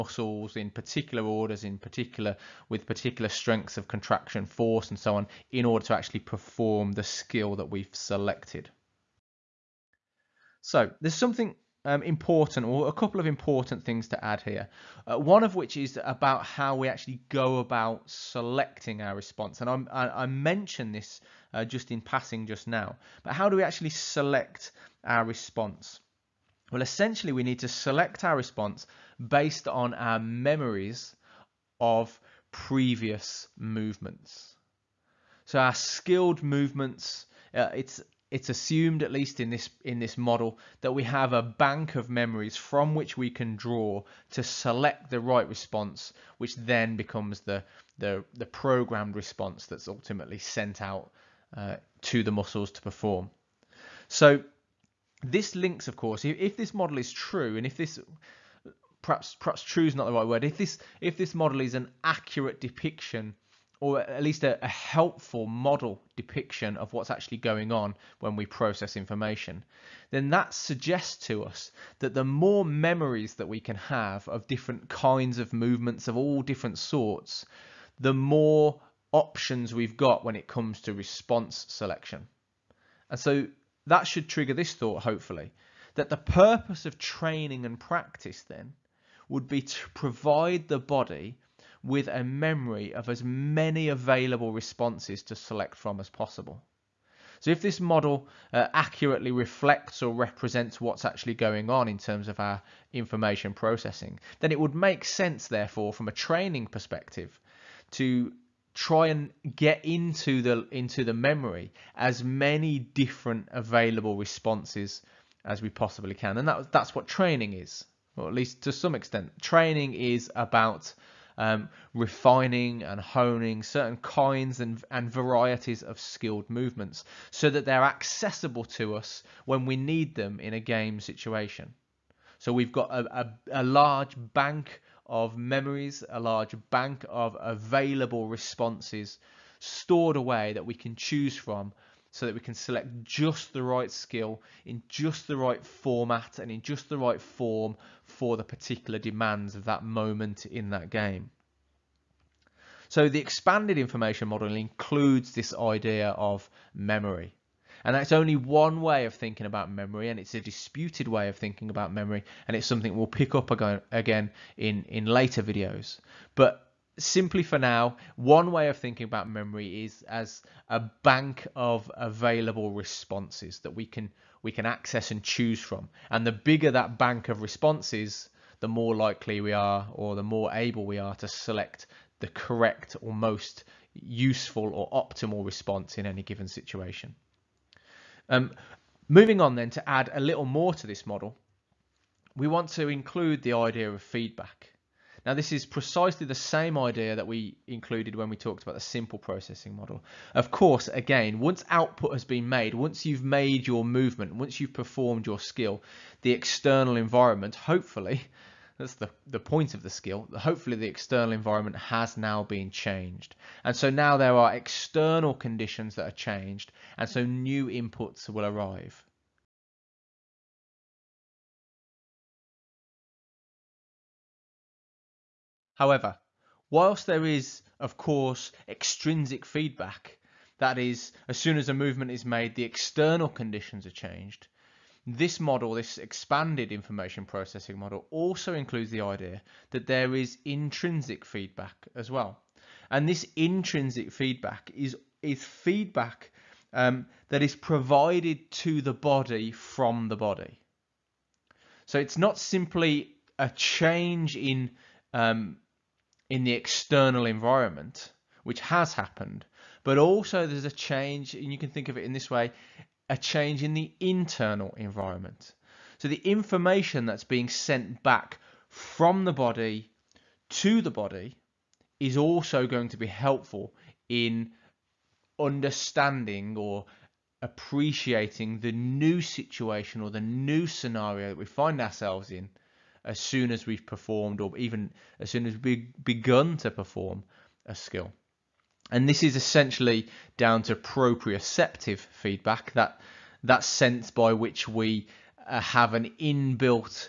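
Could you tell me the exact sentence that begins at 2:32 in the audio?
So the expanded information model includes this idea of memory.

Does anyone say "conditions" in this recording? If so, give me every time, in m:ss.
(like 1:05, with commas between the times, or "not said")
3:35, 3:53.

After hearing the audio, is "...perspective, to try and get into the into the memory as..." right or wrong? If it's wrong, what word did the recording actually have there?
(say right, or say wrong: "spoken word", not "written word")
right.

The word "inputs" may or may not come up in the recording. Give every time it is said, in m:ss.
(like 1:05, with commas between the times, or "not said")
3:37.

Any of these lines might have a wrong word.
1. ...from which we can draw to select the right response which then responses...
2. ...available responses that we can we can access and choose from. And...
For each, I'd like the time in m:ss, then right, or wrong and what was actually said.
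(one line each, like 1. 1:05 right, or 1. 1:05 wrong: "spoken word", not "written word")
1. 0:42 wrong: "becomes", not "responses"
2. 2:51 right.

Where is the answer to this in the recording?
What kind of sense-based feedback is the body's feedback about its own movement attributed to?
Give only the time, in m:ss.
4:50.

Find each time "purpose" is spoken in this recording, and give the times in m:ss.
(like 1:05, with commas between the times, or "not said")
1:26.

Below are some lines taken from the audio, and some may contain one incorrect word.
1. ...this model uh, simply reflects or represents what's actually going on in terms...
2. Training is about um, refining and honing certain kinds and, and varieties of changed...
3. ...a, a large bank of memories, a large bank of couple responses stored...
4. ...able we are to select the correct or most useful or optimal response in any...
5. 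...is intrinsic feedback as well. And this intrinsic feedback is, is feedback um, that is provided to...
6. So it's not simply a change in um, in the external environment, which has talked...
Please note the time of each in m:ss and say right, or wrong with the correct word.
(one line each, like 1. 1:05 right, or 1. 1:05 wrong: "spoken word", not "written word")
1. 1:37 wrong: "accurately", not "simply"
2. 1:59 wrong: "skilled", not "changed"
3. 2:13 wrong: "available", not "couple"
4. 3:00 right
5. 4:00 right
6. 4:11 wrong: "happened", not "talked".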